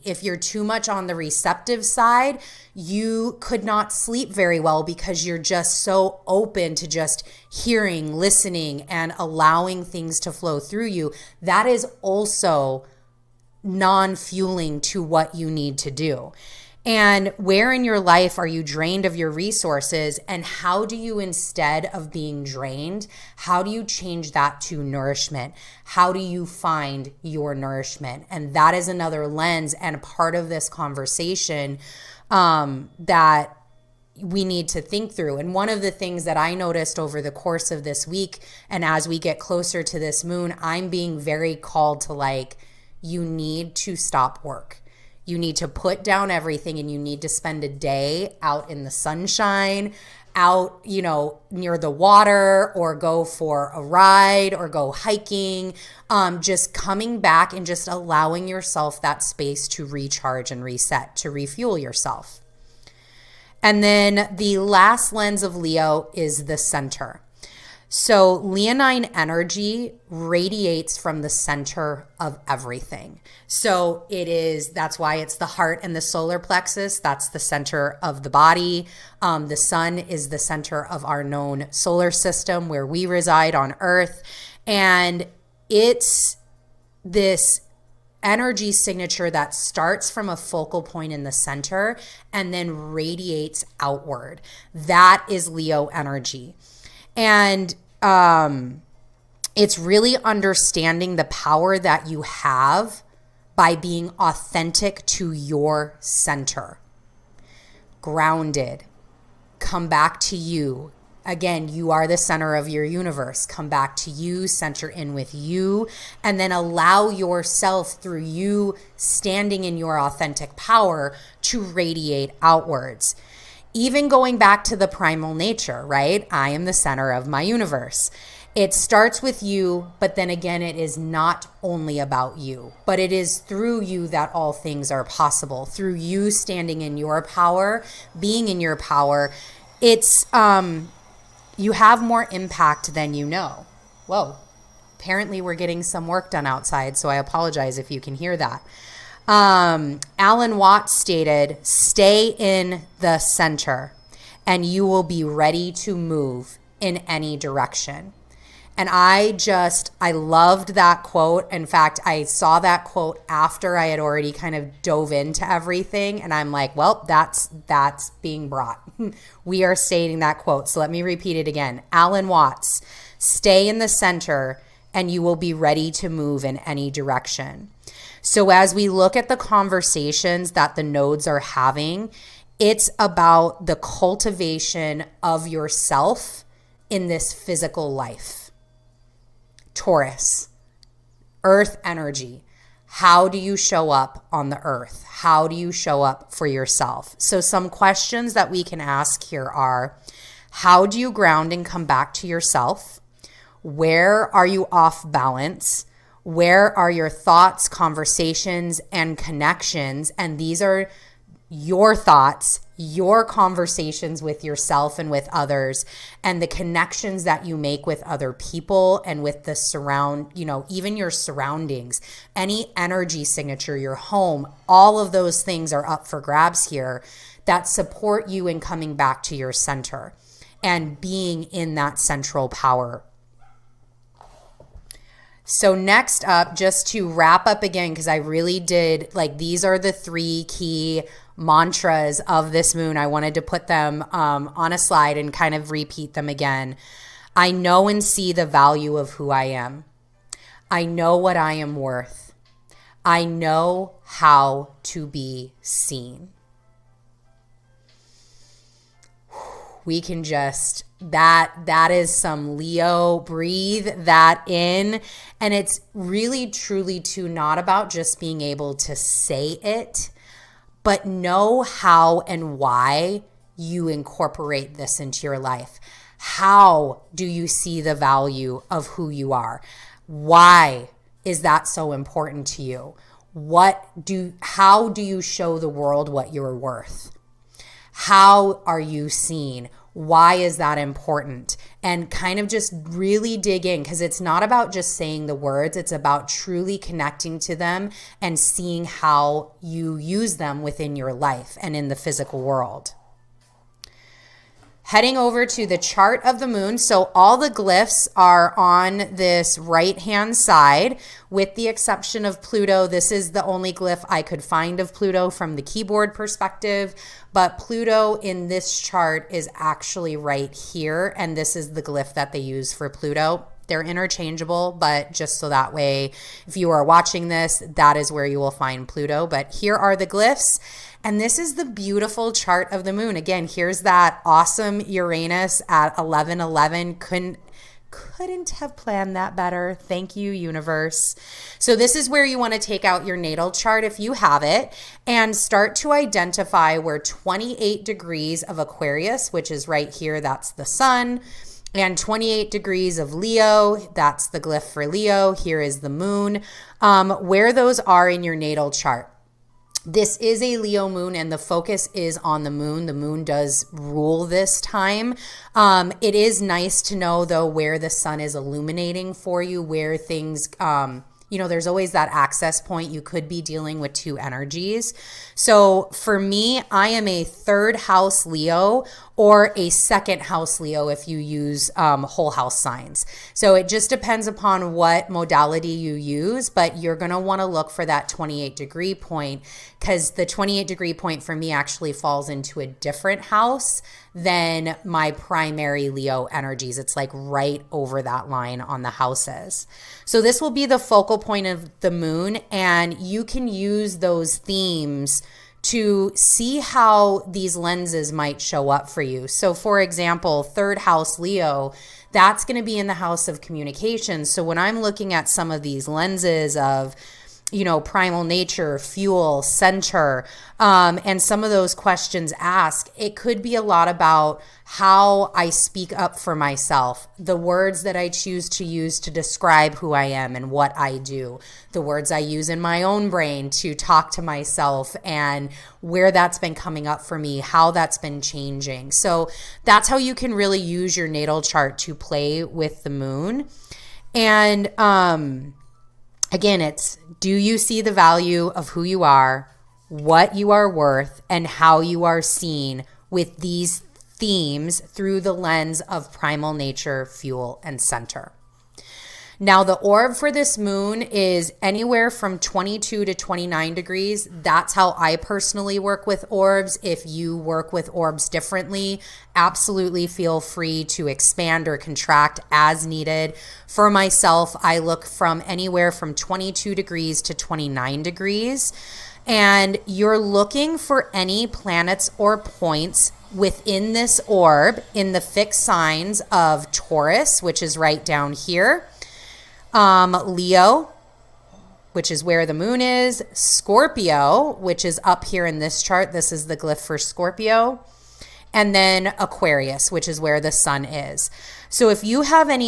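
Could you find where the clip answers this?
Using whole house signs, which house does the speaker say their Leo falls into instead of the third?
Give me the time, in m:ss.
6:19.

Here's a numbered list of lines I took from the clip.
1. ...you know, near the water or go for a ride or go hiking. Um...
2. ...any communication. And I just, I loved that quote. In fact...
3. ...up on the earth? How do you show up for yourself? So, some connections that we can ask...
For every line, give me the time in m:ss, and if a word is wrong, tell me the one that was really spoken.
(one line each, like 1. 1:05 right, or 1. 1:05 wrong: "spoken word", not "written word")
1. 0:50 right
2. 2:37 wrong: "direction", not "communication"
3. 3:13 wrong: "questions", not "connections".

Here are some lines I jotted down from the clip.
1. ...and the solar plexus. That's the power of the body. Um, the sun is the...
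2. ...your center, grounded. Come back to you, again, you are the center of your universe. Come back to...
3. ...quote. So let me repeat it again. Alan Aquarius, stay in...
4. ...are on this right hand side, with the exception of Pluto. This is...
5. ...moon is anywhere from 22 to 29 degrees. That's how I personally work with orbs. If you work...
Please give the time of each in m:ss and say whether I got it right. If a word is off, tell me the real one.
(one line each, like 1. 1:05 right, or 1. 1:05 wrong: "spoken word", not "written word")
1. 1:15 wrong: "center", not "power"
2. 1:45 right
3. 2:50 wrong: "Watts", not "Aquarius"
4. 5:08 right
5. 7:40 right.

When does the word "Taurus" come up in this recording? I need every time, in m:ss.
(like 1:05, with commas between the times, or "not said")
3:09, 8:06.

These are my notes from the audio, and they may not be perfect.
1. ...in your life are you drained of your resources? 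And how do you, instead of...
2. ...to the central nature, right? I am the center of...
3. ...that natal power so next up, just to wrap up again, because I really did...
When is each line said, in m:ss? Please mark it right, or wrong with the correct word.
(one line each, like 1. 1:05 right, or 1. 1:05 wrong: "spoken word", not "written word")
1. 0:17 right
2. 2:04 wrong: "primal", not "central"
3. 3:51 wrong: "central", not "natal".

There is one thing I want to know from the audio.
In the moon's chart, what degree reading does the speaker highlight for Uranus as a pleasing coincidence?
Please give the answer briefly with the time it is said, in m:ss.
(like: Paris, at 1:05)
1111, at 5:35.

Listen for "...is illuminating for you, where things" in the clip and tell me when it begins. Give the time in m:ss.
6:08.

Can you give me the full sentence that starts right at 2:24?
Whoa, apparently we're getting some work done outside, so I apologize if you can hear that.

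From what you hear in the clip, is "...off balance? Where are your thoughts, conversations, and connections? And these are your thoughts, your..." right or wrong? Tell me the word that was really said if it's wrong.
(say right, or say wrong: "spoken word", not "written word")
right.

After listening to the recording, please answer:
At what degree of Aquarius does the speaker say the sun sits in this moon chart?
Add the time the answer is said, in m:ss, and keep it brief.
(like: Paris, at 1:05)
28, at 5:46.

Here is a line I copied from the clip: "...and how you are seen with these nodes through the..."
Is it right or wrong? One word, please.
wrong.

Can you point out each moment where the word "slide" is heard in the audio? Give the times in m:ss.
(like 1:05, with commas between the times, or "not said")
4:04.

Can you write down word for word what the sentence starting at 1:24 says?
And it's this energy signature that starts from a focal point in the center and then radiates outward.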